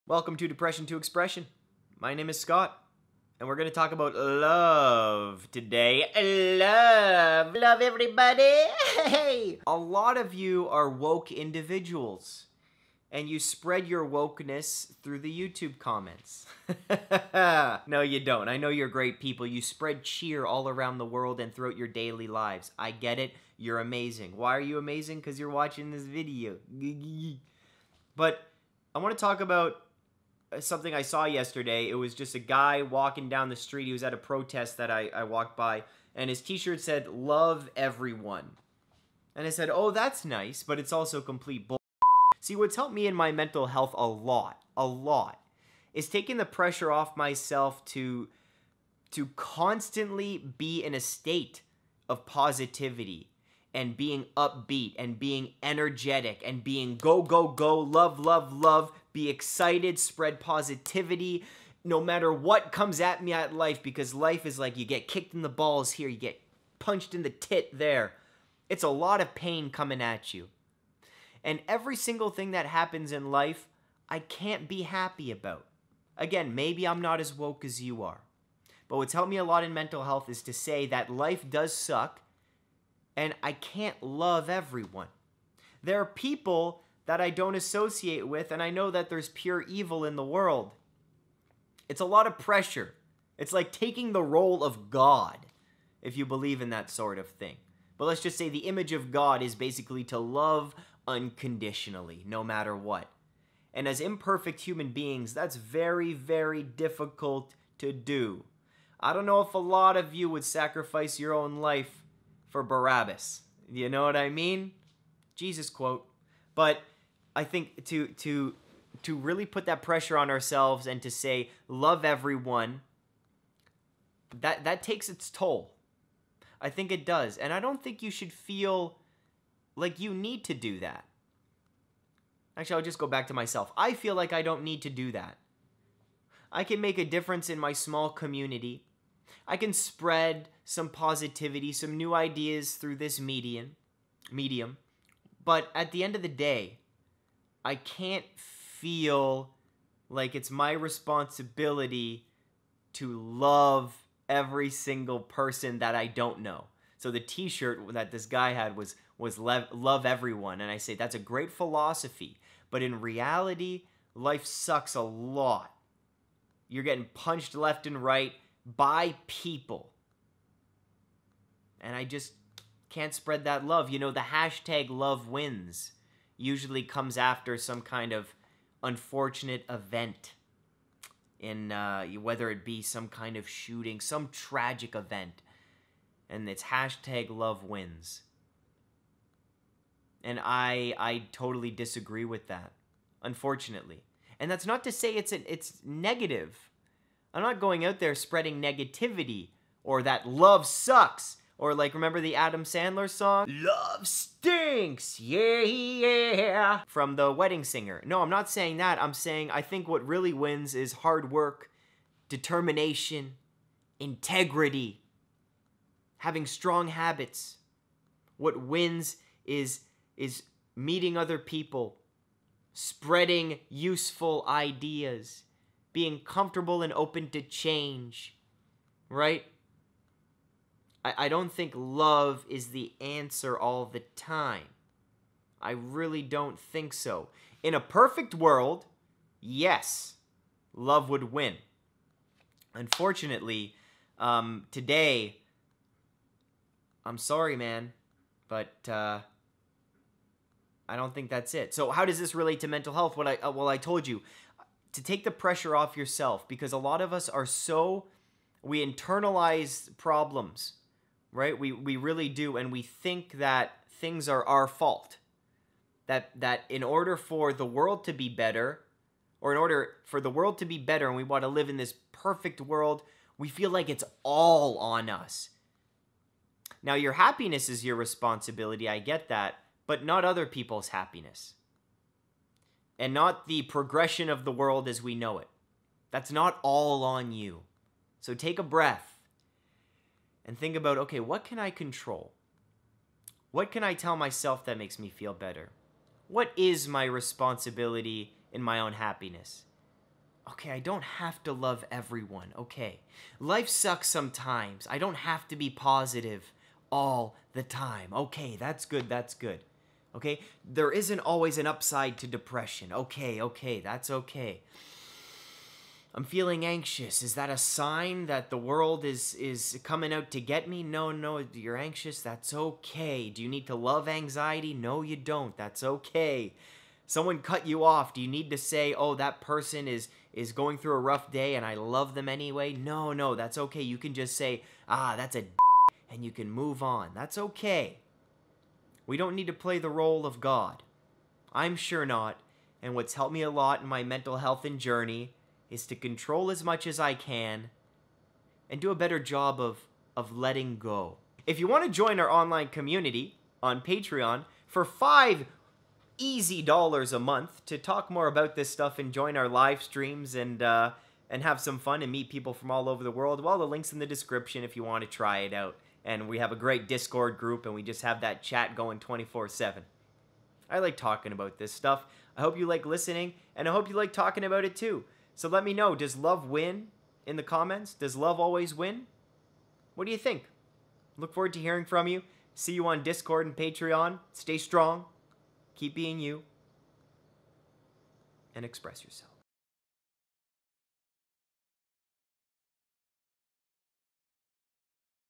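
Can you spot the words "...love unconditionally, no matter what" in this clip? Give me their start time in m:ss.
1:40.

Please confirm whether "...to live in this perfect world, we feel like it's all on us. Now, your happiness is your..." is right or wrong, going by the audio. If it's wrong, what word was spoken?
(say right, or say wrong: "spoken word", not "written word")
right.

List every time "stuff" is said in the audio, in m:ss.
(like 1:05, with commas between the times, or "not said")
5:58, 6:11.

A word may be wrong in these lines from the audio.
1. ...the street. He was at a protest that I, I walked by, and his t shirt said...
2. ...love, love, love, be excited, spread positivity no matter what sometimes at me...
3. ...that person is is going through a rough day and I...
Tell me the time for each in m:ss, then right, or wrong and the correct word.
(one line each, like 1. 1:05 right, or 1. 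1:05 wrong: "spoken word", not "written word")
1. 0:33 right
2. 0:57 wrong: "comes", not "sometimes"
3. 5:29 right.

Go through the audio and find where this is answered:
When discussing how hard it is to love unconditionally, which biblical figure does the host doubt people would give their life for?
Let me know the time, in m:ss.
1:52.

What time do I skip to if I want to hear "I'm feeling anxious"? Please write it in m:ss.
5:16.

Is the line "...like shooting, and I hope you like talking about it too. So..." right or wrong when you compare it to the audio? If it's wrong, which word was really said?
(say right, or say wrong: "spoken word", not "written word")
wrong: "listening", not "shooting".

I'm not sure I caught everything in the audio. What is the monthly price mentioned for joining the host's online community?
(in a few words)
$5.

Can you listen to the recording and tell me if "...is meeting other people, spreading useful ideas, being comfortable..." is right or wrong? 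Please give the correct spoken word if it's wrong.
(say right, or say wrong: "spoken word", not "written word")
right.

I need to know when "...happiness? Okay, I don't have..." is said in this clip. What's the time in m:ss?
4:58.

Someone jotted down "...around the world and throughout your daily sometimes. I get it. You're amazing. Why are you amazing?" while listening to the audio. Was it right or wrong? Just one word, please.
wrong.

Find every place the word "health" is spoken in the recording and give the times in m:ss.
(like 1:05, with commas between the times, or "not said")
0:43, 1:20, 4:12, 5:44.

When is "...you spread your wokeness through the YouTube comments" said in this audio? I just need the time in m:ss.
0:13.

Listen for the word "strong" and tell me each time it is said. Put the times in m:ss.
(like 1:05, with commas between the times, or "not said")
3:36, 6:24.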